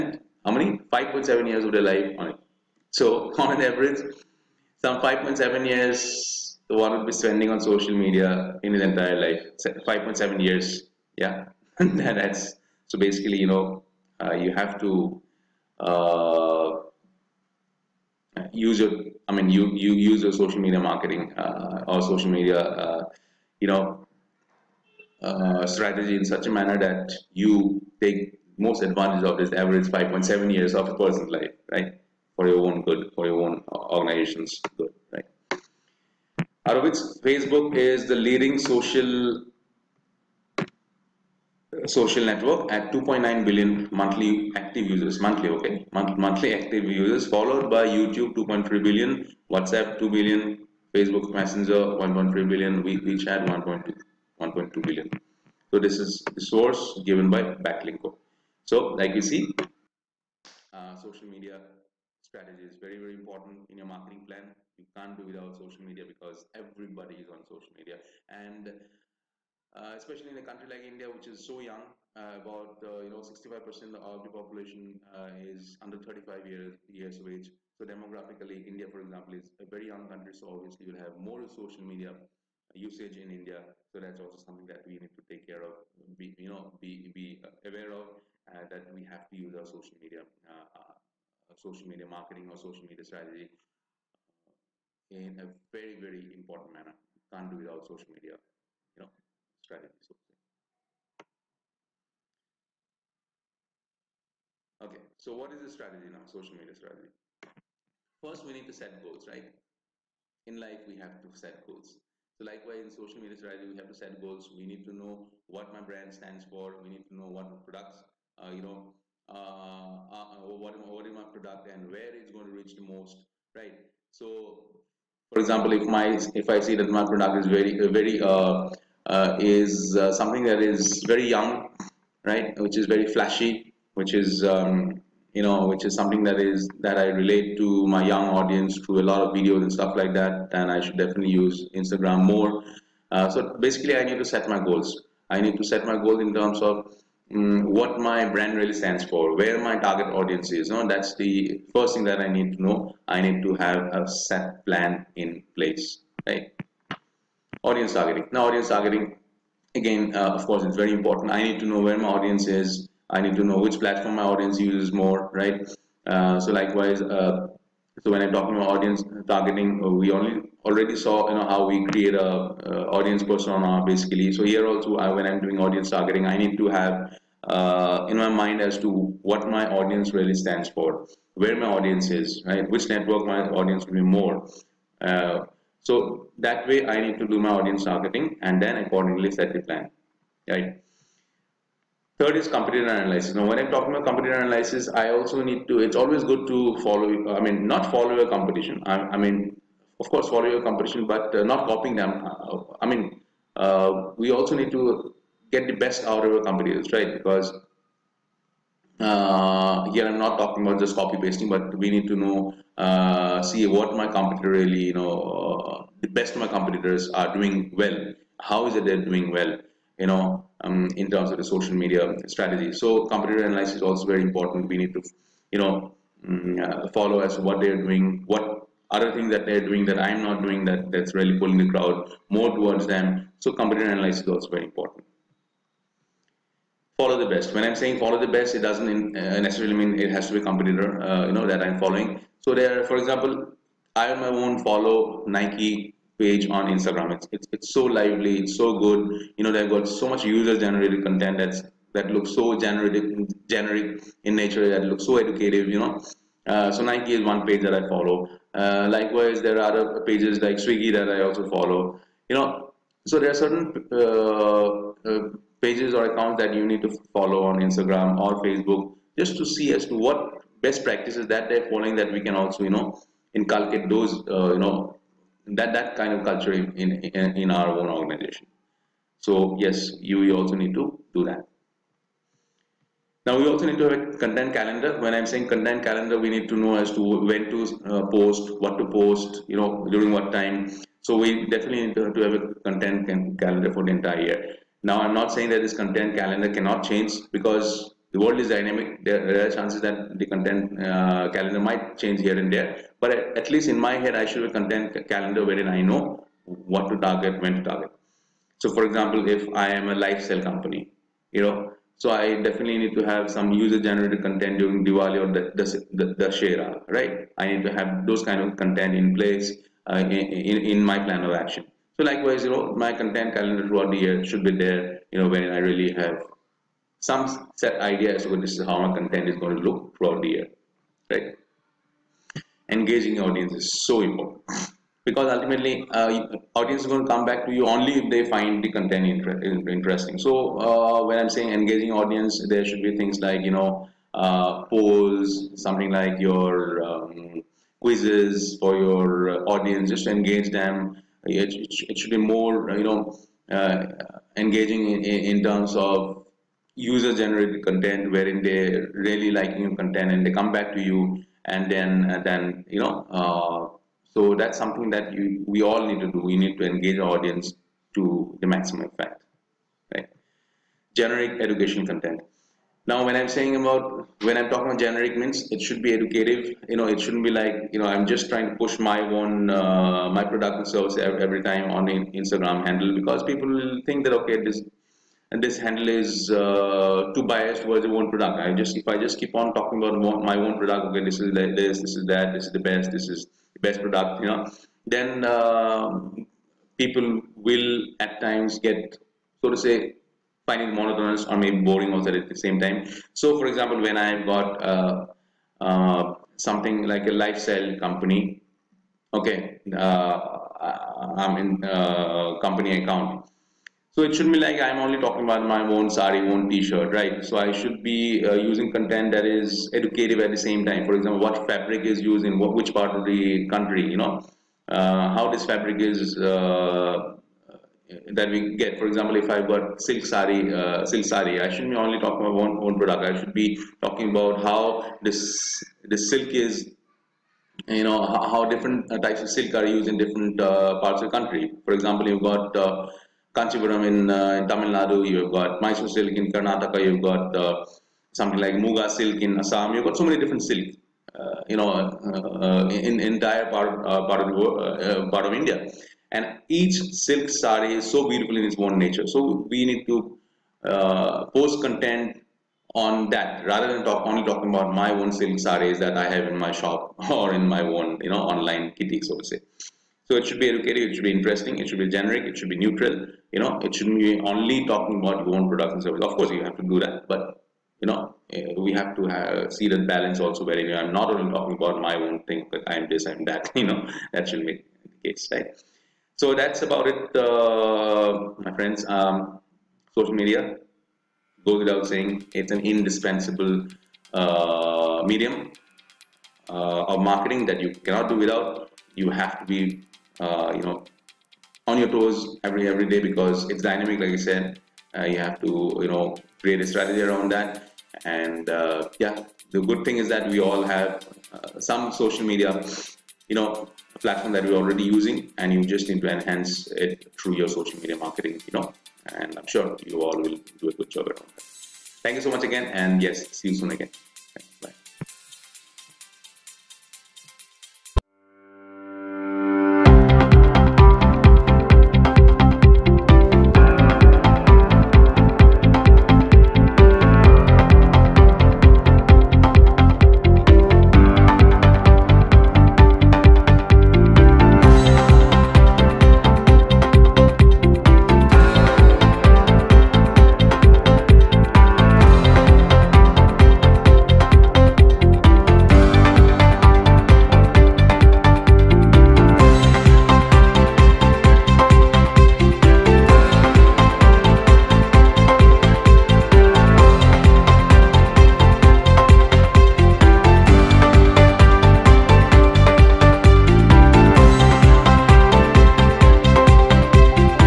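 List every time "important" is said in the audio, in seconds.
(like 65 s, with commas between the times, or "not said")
63 s, 96 s, 160 s, 224 s, 234 s, 333 s.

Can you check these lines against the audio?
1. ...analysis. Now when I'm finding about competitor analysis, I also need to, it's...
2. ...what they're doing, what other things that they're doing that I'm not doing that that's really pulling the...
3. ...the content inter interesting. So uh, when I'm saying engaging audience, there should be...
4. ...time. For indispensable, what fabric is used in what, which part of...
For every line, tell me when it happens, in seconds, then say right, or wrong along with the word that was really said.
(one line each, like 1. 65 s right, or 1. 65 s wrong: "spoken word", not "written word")
1. 192 s wrong: "talking", not "finding"
2. 227 s right
3. 338 s right
4. 420 s wrong: "example", not "indispensable".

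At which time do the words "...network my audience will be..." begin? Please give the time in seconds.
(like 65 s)
182 s.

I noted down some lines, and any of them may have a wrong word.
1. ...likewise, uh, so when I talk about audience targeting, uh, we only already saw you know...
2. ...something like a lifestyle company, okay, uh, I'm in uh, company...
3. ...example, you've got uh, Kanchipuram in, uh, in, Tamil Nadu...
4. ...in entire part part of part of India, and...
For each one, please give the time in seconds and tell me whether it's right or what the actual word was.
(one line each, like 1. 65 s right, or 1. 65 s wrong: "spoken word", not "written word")
1. 166 s right
2. 406 s right
3. 441 s right
4. 452 s right.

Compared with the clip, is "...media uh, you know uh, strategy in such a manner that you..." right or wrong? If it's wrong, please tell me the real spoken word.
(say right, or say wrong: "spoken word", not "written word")
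right.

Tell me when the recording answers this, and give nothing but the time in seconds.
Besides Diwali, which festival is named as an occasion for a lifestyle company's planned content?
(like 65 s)
316 s.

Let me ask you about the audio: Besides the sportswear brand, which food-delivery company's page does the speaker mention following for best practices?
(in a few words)
Swiggy.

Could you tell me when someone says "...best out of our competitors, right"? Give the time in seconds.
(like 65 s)
205 s.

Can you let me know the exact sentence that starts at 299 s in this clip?
There are chances that the content uh, calendar might change here and there.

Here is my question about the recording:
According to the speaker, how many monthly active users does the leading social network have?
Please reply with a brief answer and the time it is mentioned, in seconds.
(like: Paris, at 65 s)
2.9 billion, at 42 s.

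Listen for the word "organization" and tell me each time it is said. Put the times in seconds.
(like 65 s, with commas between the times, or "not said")
33 s, 277 s.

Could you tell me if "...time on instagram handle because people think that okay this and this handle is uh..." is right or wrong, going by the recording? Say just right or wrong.
right.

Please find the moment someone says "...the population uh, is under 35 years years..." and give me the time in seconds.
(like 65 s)
74 s.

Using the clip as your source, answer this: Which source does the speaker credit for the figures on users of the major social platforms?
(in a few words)
Backlinko.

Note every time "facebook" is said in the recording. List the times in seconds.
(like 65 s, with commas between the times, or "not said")
37 s, 50 s, 268 s.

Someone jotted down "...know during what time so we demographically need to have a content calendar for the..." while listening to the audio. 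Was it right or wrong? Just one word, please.
wrong.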